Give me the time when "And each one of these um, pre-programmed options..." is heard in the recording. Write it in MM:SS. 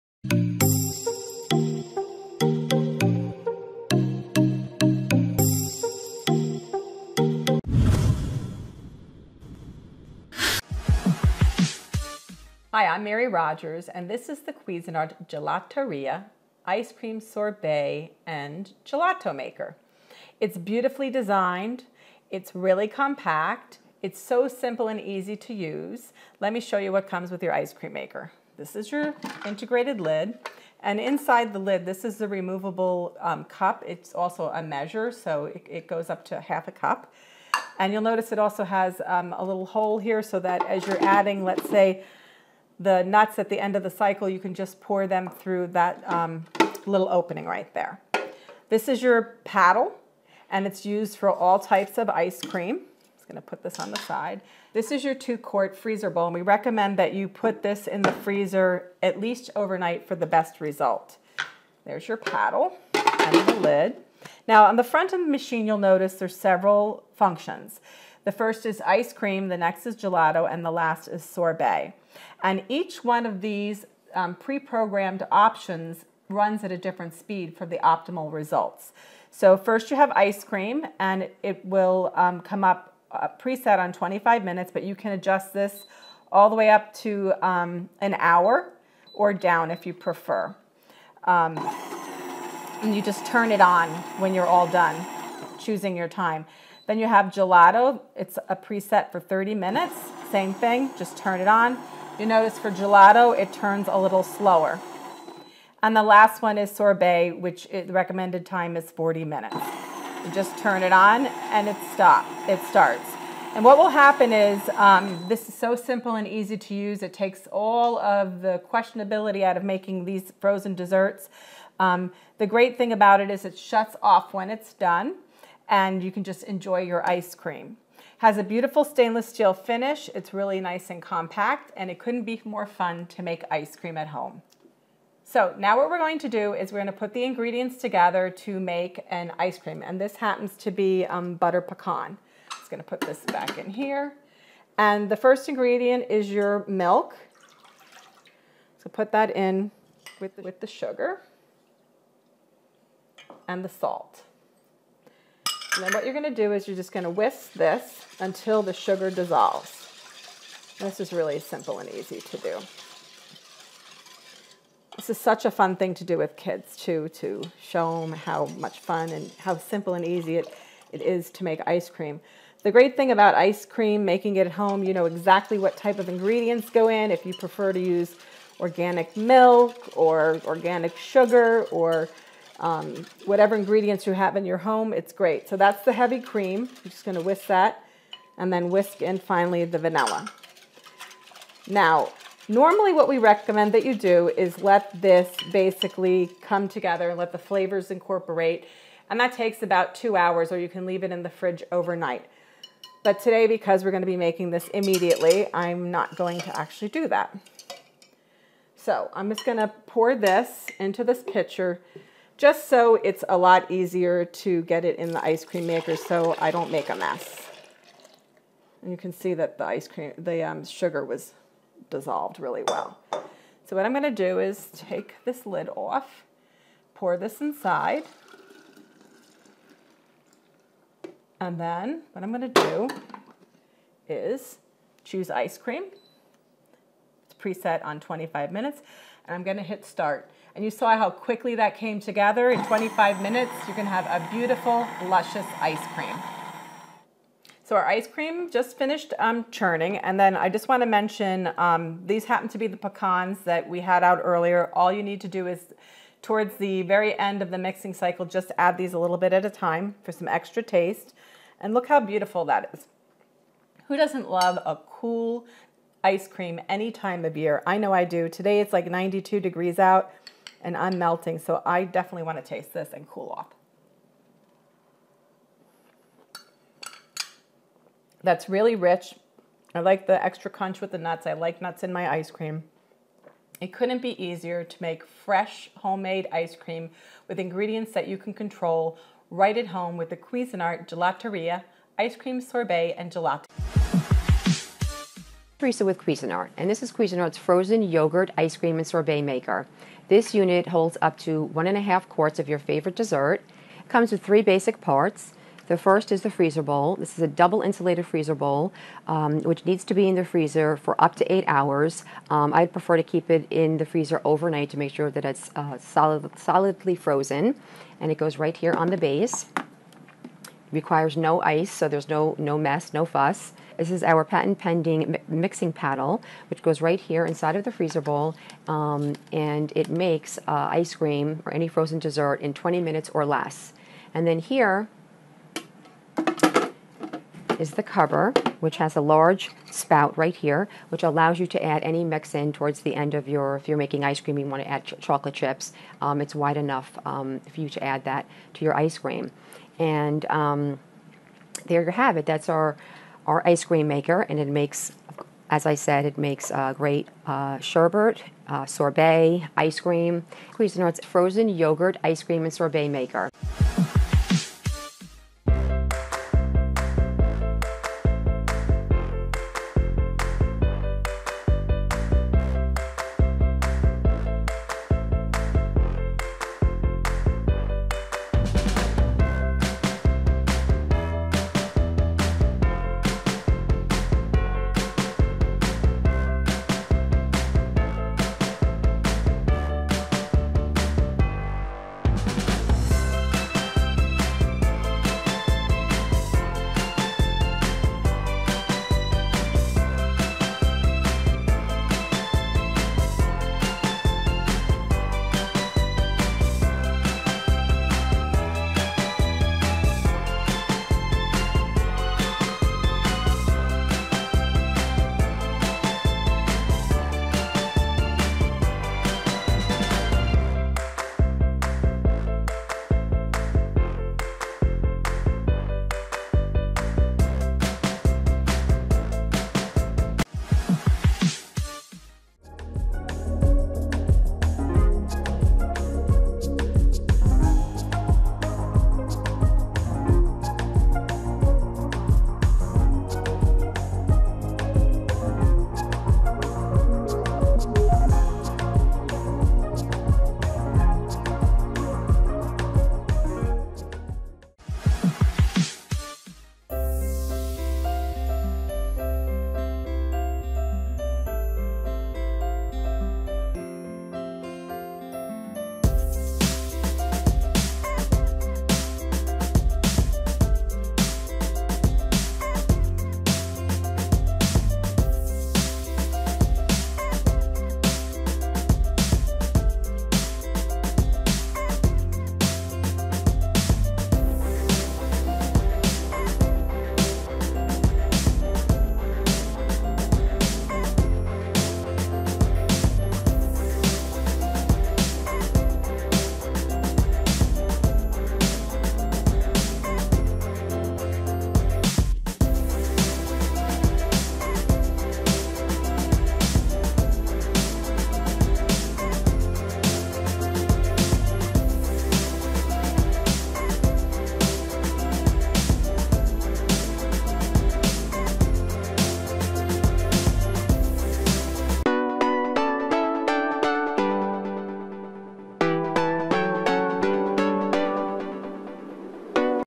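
01:12.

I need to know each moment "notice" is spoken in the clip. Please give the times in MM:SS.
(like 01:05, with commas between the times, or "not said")
00:38, 01:05, 01:42.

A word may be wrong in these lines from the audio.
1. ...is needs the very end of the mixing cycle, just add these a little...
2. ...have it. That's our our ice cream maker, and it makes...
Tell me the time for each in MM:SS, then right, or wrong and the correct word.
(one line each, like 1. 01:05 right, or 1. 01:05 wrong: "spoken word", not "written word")
1. 04:15 wrong: "towards", not "needs"
2. 05:51 right.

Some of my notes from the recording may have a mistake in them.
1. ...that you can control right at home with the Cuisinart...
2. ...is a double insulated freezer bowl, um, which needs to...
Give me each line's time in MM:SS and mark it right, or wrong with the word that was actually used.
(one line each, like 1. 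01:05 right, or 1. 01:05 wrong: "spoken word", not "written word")
1. 04:47 right
2. 05:07 right.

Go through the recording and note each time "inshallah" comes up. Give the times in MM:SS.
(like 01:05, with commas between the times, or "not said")
not said.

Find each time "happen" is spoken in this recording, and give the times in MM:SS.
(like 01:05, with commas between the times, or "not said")
01:53, 02:20, 04:12.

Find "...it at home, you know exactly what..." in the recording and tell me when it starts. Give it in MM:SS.
02:54.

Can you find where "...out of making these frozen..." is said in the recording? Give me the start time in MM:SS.
01:59.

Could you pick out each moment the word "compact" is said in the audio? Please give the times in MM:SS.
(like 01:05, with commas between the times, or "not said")
00:22, 02:11.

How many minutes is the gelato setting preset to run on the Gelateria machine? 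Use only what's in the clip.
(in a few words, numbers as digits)
30 minutes.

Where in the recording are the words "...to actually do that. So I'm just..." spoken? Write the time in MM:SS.
03:26.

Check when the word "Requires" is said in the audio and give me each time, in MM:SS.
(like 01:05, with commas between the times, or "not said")
05:20.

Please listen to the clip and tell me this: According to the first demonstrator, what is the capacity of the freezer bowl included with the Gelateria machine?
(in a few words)
2 quart.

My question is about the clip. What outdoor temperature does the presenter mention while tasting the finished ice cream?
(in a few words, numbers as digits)
92 degrees.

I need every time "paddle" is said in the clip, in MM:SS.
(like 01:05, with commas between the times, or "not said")
00:49, 01:02, 05:25.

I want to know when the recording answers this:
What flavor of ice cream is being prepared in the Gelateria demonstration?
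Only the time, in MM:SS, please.
02:21.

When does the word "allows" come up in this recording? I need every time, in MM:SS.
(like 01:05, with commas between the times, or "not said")
05:41.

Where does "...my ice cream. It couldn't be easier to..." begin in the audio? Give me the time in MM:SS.
04:41.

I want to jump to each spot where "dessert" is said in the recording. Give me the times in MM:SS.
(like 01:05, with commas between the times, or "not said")
02:00, 05:02, 05:31.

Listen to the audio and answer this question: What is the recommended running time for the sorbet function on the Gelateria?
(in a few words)
40 minutes.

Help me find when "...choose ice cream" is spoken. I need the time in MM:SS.
03:55.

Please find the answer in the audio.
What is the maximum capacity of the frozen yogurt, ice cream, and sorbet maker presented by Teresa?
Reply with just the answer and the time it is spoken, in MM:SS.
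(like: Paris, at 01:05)
1.5 quarts, at 05:01.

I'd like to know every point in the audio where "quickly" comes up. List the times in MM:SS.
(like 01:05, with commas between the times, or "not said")
04:01.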